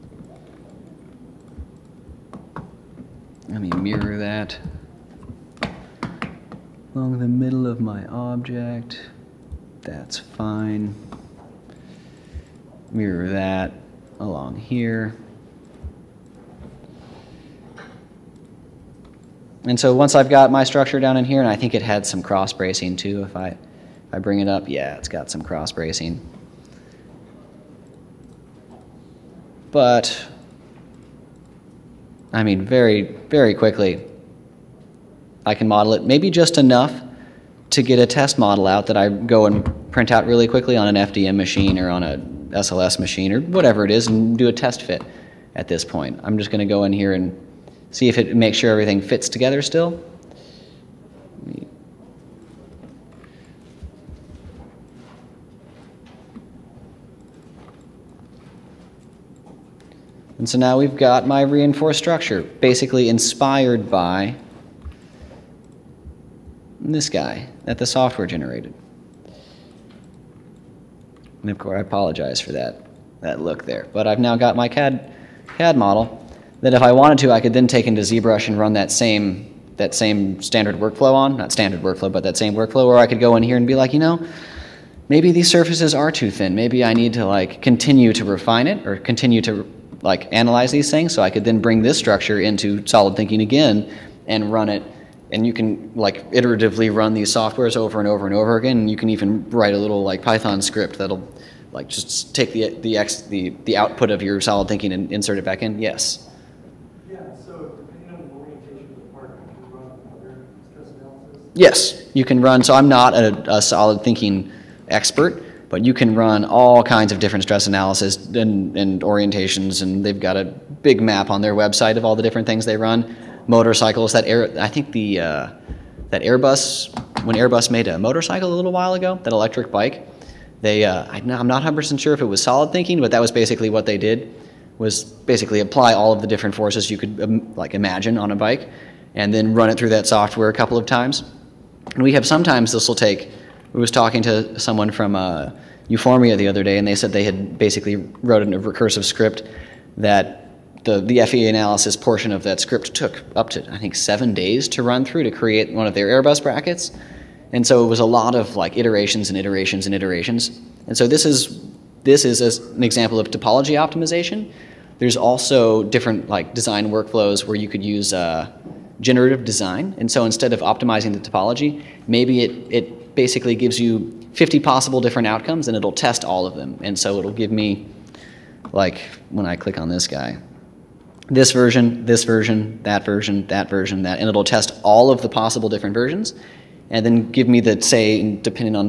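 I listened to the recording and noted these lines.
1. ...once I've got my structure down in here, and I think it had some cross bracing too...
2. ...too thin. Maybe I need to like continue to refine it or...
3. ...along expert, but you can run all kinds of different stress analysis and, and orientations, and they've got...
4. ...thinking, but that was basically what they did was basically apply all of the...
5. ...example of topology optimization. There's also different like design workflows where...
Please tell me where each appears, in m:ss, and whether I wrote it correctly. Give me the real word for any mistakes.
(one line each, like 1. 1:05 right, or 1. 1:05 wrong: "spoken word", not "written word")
1. 0:19 right
2. 1:26 right
3. 1:54 wrong: "thinking", not "along"
4. 2:12 right
5. 2:42 right.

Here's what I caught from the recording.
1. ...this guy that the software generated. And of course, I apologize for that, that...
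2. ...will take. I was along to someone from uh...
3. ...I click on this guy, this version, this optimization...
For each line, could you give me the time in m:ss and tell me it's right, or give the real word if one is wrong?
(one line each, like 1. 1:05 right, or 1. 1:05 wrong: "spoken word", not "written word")
1. 1:06 right
2. 2:22 wrong: "talking", not "along"
3. 2:59 wrong: "version", not "optimization".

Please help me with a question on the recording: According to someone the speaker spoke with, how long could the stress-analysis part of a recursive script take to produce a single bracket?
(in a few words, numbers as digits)
7 days.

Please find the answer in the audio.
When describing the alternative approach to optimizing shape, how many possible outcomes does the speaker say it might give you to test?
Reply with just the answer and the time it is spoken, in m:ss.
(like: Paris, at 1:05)
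50, at 2:54.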